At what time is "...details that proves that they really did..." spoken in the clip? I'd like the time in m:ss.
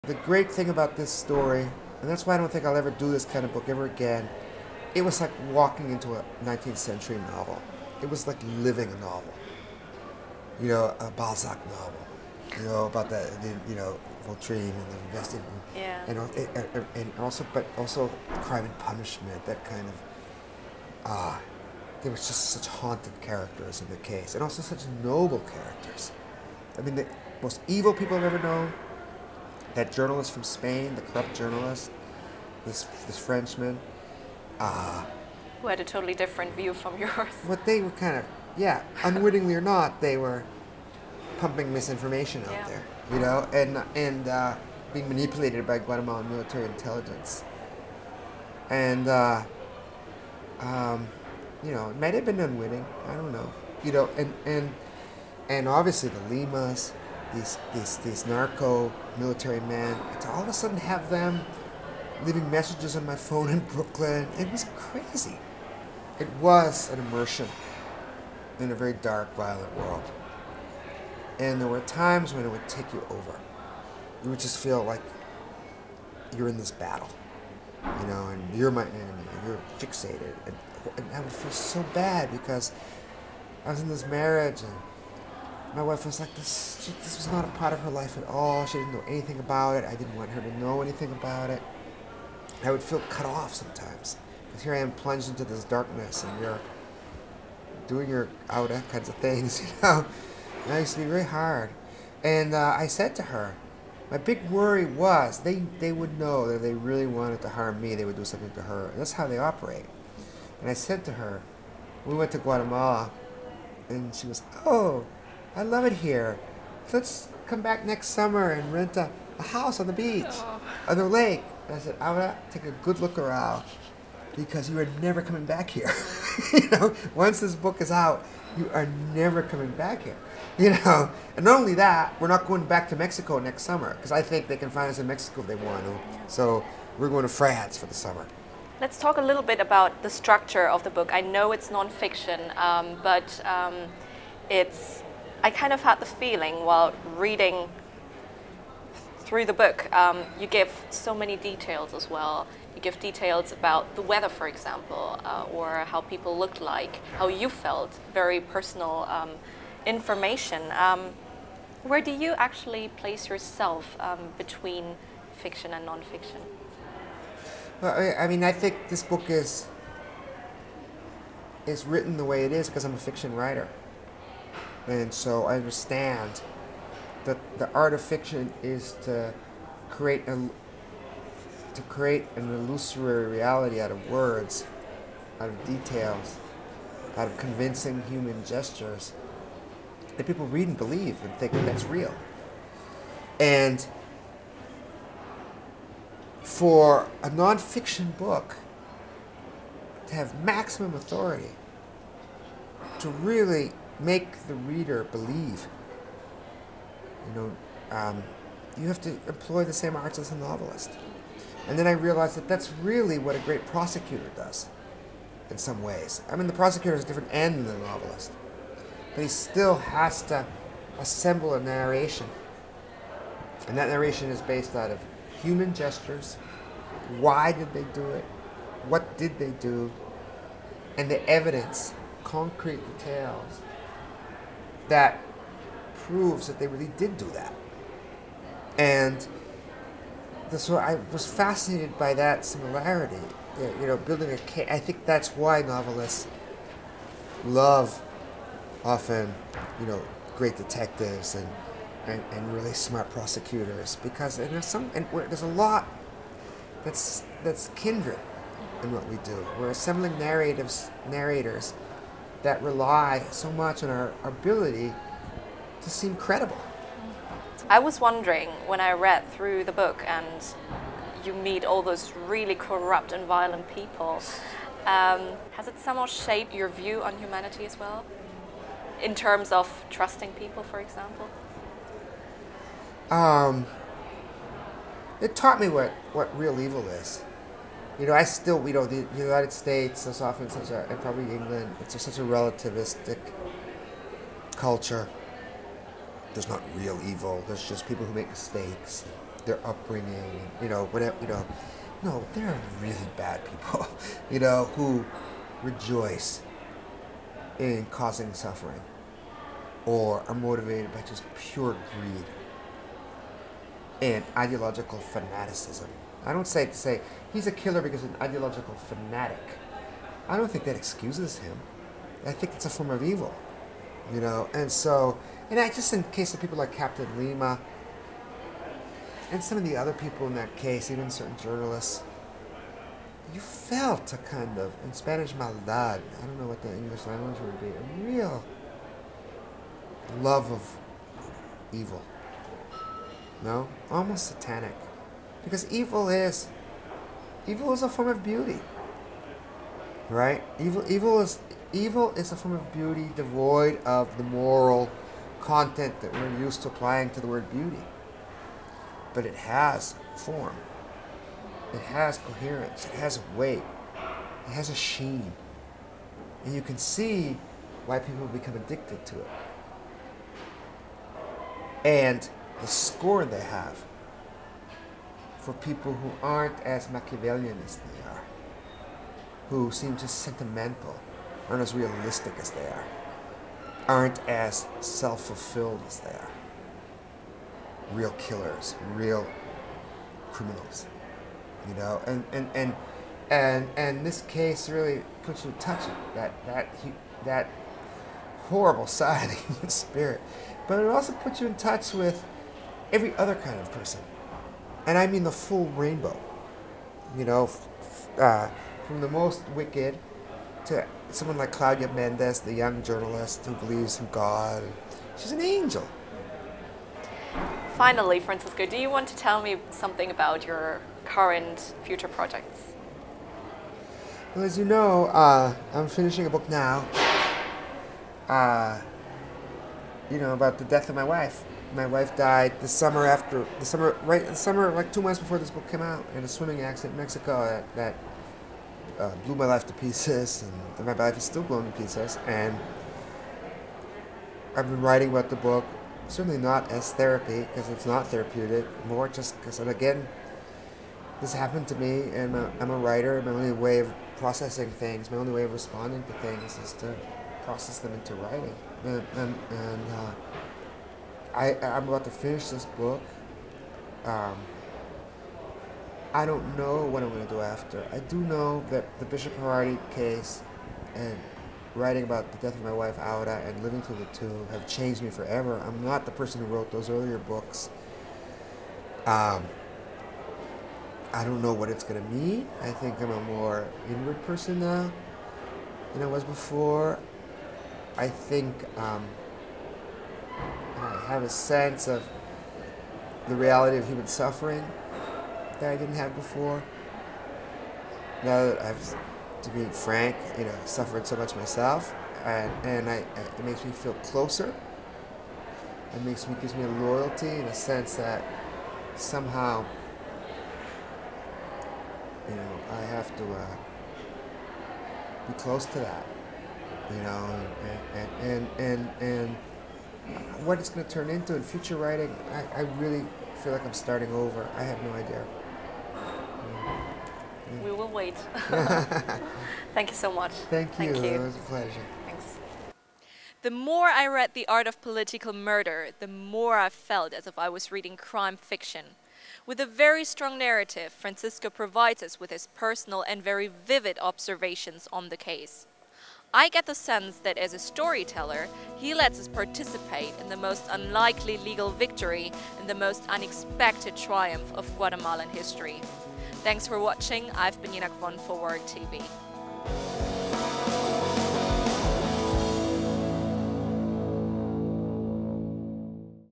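3:52.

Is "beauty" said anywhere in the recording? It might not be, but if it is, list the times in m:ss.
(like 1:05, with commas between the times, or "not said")
5:48, 5:52, 5:57.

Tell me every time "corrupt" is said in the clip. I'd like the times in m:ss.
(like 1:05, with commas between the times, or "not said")
0:31, 4:32.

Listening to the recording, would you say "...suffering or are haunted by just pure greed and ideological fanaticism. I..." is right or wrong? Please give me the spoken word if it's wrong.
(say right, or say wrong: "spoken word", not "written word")
wrong: "motivated", not "haunted".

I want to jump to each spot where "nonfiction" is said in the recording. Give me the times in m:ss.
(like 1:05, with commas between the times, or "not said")
2:21, 2:45, 3:17.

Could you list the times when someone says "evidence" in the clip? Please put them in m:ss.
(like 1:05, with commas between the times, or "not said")
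3:51.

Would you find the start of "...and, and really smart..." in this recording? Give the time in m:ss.
4:12.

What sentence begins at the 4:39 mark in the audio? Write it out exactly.
In terms of trusting people, for example?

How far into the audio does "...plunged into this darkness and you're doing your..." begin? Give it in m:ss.
1:34.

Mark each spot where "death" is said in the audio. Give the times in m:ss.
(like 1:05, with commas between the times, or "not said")
7:10, 7:52.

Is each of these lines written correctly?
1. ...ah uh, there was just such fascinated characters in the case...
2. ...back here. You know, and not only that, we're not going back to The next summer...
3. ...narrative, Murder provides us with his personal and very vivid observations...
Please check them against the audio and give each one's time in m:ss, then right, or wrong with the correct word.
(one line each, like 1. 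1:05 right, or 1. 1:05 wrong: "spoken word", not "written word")
1. 0:21 wrong: "haunted", not "fascinated"
2. 2:09 wrong: "Mexico", not "The"
3. 9:00 wrong: "Francisco", not "Murder".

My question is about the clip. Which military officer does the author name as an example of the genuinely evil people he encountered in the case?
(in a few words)
Captain Lima.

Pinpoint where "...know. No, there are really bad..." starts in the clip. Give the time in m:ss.
5:01.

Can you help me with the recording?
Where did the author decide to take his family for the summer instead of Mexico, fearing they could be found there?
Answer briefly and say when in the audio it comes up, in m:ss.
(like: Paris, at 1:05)
France, at 2:17.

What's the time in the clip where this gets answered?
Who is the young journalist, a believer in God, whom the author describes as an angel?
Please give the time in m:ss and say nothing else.
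6:51.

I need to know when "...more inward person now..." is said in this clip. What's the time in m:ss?
8:03.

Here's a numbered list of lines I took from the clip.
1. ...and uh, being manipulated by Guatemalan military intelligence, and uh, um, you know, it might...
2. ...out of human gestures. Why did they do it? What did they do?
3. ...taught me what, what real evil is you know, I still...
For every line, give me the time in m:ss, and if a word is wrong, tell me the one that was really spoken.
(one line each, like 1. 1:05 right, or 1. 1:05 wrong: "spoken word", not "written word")
1. 0:43 right
2. 3:44 right
3. 4:45 right.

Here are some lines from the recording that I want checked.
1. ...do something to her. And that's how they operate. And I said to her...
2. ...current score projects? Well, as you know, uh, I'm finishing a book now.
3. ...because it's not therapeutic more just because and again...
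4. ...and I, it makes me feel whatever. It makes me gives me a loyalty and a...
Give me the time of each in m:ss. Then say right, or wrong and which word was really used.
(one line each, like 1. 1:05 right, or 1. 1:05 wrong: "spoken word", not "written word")
1. 1:48 right
2. 7:01 wrong: "future", not "score"
3. 7:27 right
4. 8:22 wrong: "closer", not "whatever".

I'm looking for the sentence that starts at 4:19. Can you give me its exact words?
We're assembling narratives narrators that rely so much on our, our ability to seem credible.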